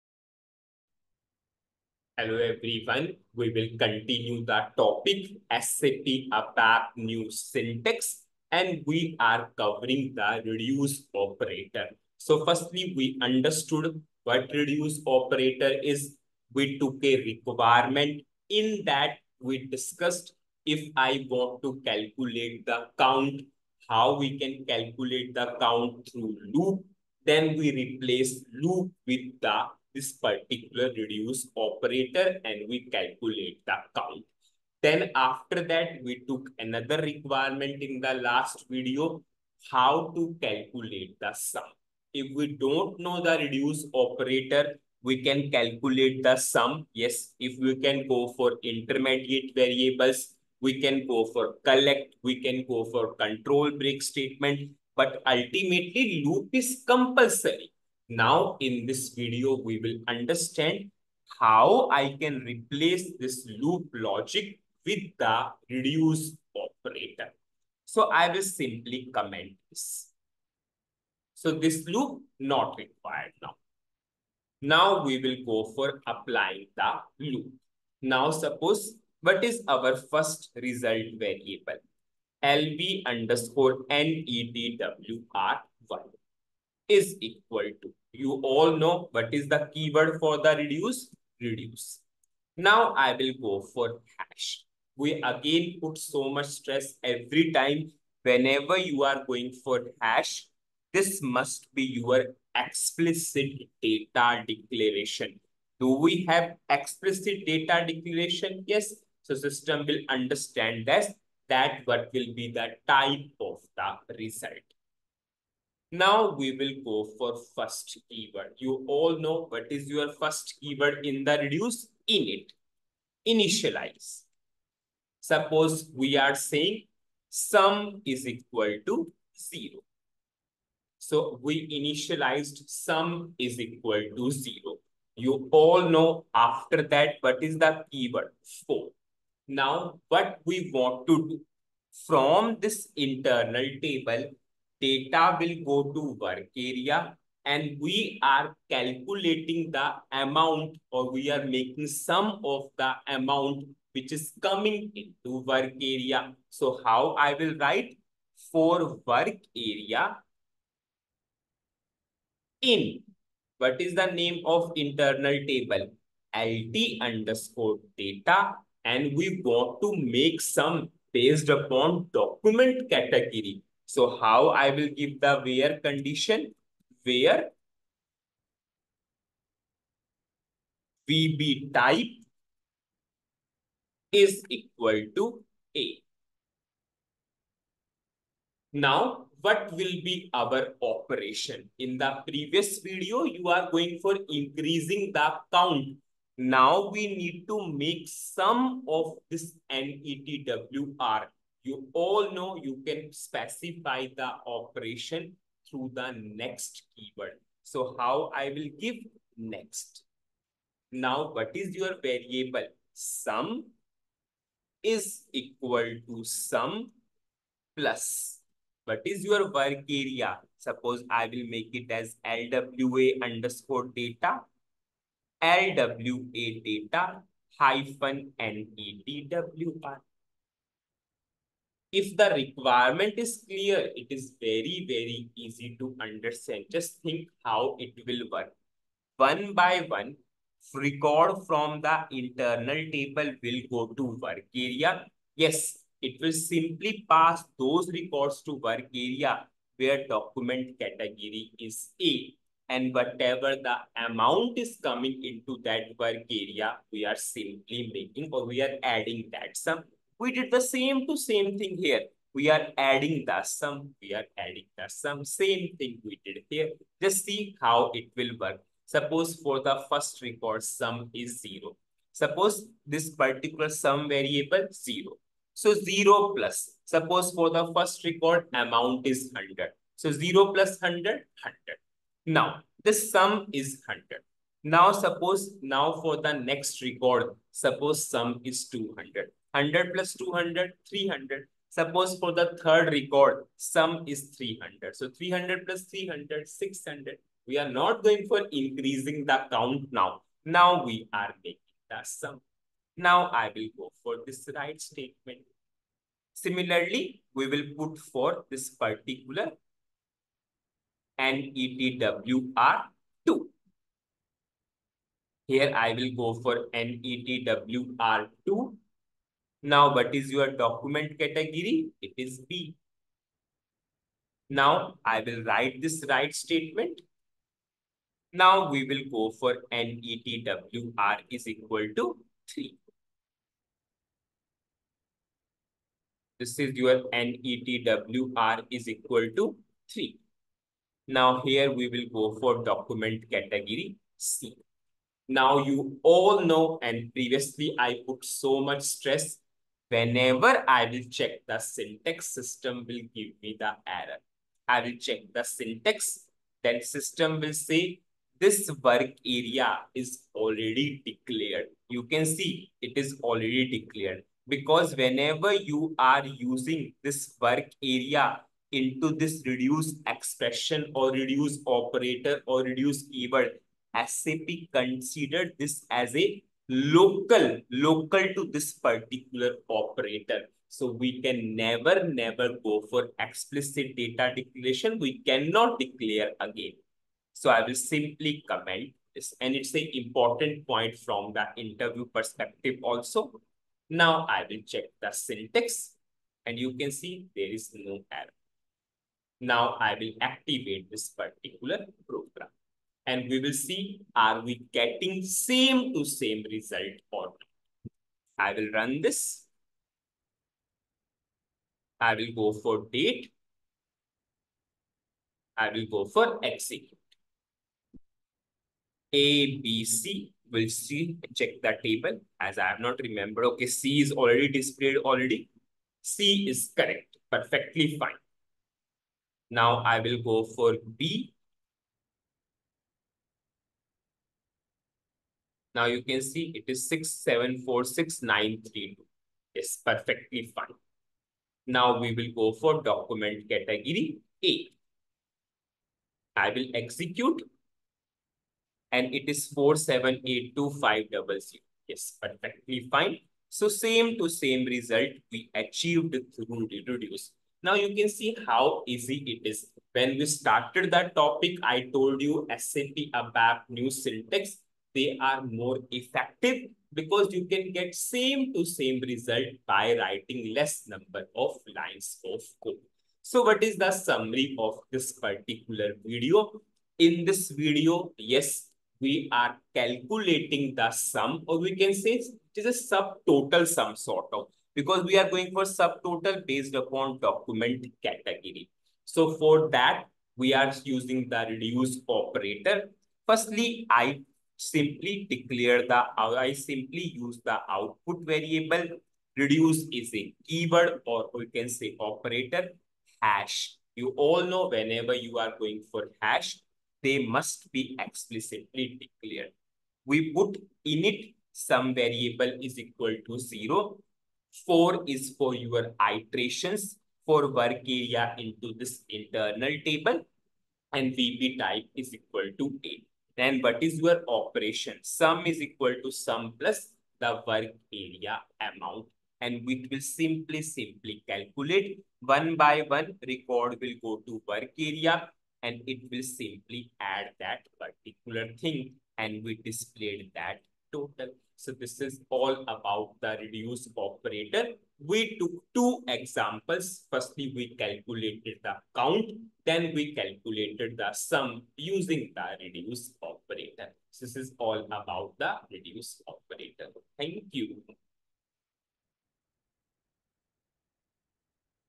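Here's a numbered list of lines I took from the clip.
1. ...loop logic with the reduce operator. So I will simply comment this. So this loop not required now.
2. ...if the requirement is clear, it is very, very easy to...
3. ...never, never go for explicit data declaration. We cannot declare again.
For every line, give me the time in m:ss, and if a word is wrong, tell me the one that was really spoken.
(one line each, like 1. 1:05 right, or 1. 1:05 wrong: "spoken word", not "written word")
1. 1:03 right
2. 3:51 right
3. 6:21 right.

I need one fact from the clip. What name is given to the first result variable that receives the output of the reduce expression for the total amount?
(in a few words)
LV_NETWR1.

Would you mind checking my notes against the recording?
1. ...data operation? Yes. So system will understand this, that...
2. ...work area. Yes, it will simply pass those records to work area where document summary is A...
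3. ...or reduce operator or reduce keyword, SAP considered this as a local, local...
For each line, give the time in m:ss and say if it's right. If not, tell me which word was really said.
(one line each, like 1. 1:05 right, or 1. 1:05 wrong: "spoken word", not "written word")
1. 1:47 wrong: "declaration", not "operation"
2. 4:04 wrong: "category", not "summary"
3. 6:10 right.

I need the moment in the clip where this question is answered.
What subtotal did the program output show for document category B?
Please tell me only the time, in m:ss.
7:16.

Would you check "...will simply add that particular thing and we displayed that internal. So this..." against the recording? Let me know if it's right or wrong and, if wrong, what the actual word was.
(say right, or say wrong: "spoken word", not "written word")
wrong: "total", not "internal".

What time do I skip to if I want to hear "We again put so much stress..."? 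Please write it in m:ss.
1:35.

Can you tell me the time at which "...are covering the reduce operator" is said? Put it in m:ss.
0:09.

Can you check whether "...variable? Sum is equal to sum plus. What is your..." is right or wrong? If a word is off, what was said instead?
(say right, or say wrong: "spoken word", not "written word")
right.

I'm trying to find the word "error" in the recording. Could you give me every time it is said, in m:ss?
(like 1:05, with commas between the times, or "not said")
5:53, 6:38.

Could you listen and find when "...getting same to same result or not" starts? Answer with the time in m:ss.
6:44.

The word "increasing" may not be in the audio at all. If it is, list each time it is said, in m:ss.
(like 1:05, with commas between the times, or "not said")
3:14, 4:58.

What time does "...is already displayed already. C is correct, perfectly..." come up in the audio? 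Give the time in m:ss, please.
7:04.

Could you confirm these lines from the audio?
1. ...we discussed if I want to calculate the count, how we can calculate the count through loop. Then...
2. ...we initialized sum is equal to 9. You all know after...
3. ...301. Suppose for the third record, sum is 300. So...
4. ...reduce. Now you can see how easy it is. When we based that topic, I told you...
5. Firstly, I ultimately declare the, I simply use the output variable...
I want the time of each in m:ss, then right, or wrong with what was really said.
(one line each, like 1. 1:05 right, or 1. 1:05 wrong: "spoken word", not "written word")
1. 0:19 right
2. 2:11 wrong: "0", not "9"
3. 4:50 wrong: "300", not "301"
4. 7:36 wrong: "started", not "based"
5. 8:13 wrong: "simply", not "ultimately".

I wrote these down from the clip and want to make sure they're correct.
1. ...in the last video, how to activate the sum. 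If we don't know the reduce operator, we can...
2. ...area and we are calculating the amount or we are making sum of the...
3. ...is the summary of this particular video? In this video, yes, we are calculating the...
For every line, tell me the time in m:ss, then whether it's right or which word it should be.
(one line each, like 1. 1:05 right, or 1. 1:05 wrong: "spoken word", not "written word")
1. 0:37 wrong: "calculate", not "activate"
2. 2:26 right
3. 7:53 right.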